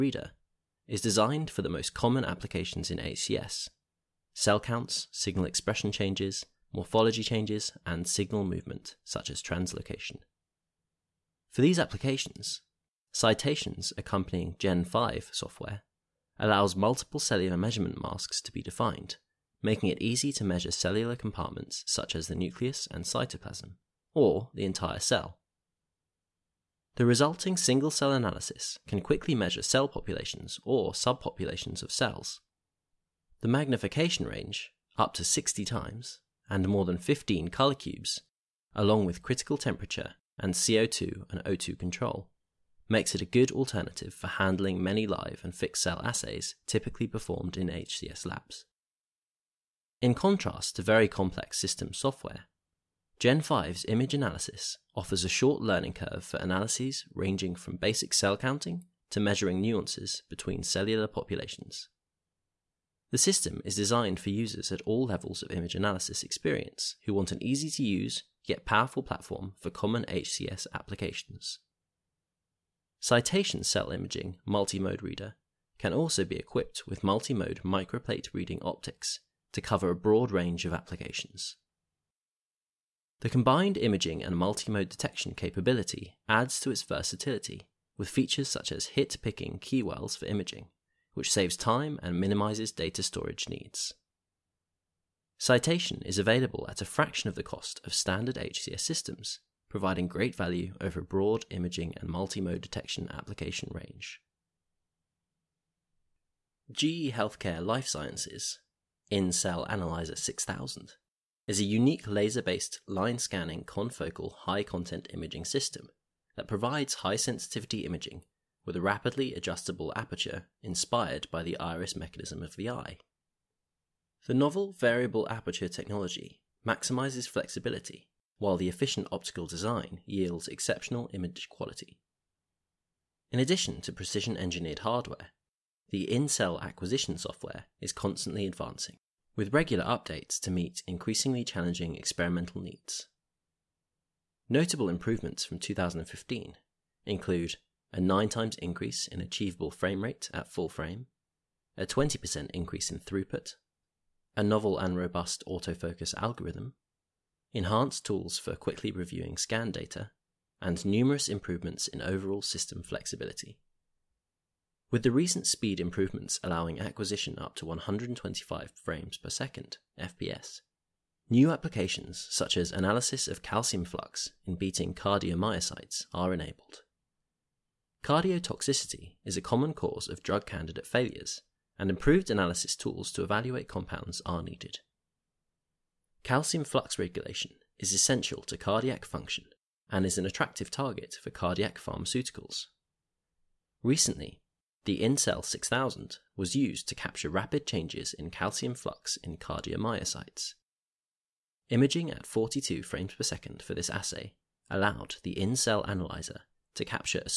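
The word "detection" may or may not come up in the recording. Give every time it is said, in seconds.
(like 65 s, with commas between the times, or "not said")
84 s, 102 s.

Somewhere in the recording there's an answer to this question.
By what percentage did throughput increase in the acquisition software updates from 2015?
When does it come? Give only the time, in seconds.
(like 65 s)
151 s.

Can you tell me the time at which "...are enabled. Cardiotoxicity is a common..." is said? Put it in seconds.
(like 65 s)
176 s.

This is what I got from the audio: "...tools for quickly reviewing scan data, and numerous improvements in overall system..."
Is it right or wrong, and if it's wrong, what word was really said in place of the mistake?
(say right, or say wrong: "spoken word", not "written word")
right.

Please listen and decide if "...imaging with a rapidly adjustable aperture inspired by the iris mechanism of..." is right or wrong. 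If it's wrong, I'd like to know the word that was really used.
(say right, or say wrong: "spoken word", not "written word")
right.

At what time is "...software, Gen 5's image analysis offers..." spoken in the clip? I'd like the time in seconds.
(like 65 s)
51 s.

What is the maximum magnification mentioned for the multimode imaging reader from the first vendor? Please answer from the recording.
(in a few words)
60 times.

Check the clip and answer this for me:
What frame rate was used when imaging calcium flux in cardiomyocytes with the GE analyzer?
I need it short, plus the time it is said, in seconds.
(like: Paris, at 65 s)
42 frames per second, at 202 s.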